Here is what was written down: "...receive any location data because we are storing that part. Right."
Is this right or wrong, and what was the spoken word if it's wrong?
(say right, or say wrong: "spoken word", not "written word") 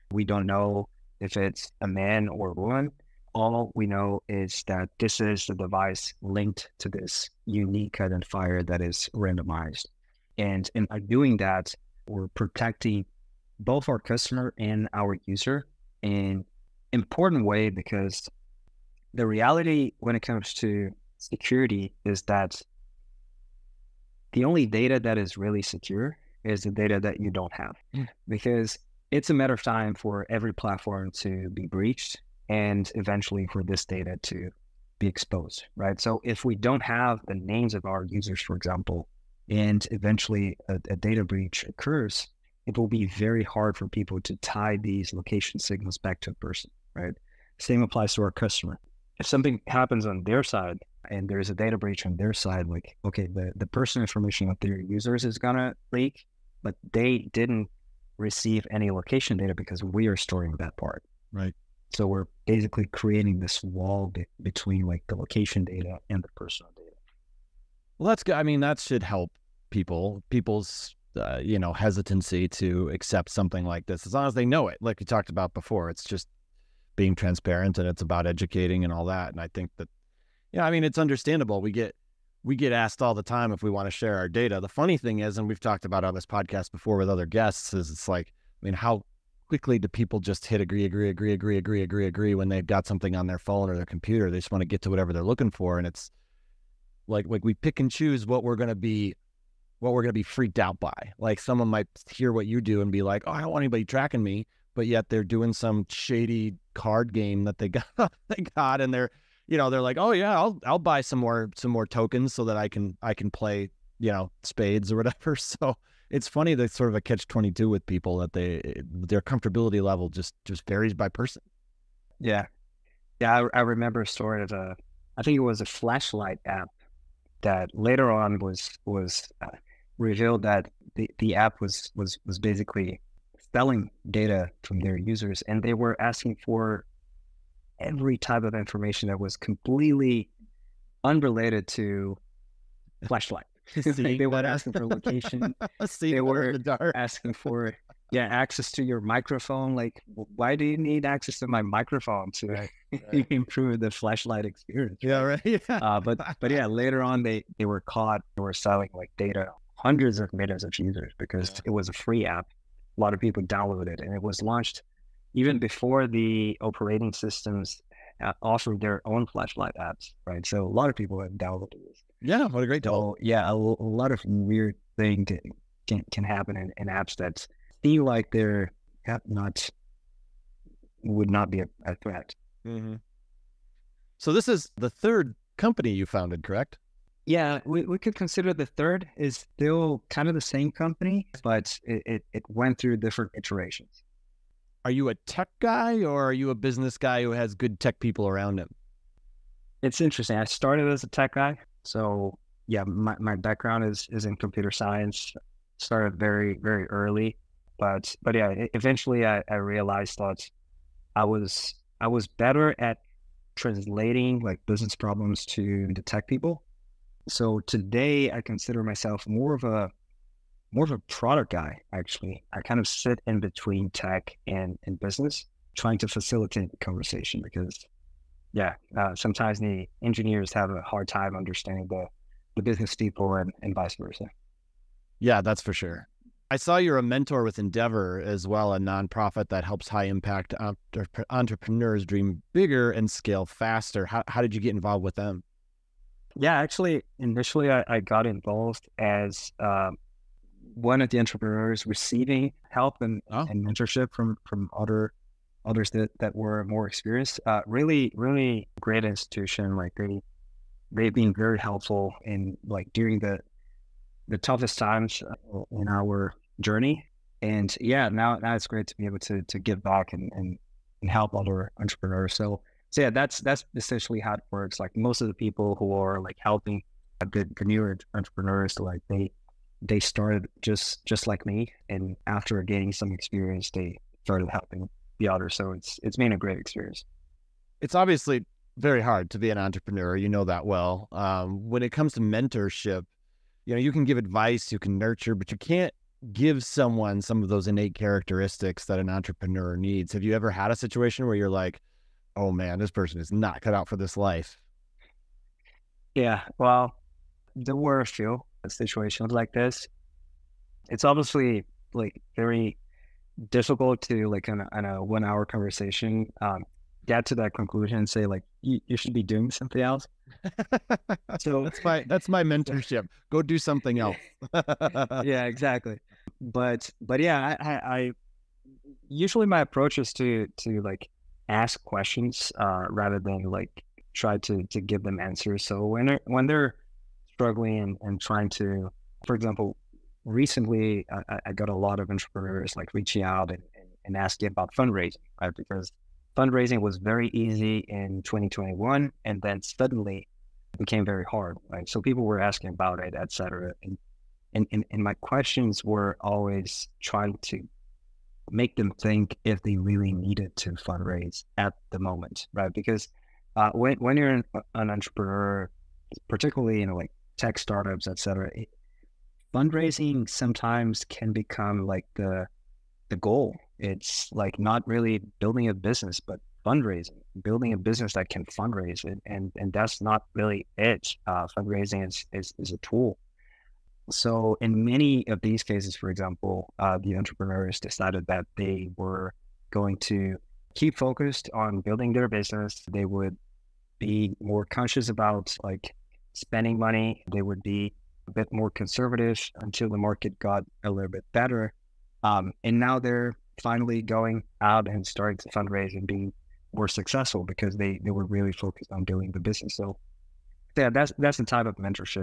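right.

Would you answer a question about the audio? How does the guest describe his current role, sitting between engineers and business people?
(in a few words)
Product guy.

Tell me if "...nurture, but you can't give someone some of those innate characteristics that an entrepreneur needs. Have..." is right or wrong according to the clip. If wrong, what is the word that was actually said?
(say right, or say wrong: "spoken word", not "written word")
right.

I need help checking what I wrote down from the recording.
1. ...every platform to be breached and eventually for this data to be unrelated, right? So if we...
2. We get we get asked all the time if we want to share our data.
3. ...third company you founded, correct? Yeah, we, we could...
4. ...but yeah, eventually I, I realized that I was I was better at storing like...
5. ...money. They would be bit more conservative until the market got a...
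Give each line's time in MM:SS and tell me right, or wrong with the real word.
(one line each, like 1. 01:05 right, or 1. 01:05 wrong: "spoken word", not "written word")
1. 00:30 wrong: "exposed", not "unrelated"
2. 01:21 right
3. 03:04 right
4. 03:28 wrong: "translating", not "storing"
5. 06:36 right.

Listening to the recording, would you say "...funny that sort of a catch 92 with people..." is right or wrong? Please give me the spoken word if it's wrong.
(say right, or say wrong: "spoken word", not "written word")
wrong: "22", not "92".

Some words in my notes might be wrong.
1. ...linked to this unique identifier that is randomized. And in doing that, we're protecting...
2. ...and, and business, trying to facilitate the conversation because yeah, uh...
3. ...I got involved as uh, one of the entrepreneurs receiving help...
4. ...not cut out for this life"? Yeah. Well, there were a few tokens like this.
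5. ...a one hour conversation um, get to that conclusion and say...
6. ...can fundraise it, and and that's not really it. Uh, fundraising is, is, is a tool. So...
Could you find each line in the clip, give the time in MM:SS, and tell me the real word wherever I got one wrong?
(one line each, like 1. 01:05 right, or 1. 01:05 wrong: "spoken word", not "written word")
1. 00:06 right
2. 03:44 right
3. 04:07 right
4. 05:03 wrong: "situations", not "tokens"
5. 05:14 right
6. 06:18 right.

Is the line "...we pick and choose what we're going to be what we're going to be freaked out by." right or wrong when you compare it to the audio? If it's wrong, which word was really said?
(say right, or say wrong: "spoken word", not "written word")
right.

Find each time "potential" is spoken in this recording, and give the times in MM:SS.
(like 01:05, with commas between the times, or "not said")
not said.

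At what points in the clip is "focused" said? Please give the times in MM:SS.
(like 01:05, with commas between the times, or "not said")
06:30, 06:48.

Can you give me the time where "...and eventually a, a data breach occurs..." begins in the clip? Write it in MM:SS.
00:39.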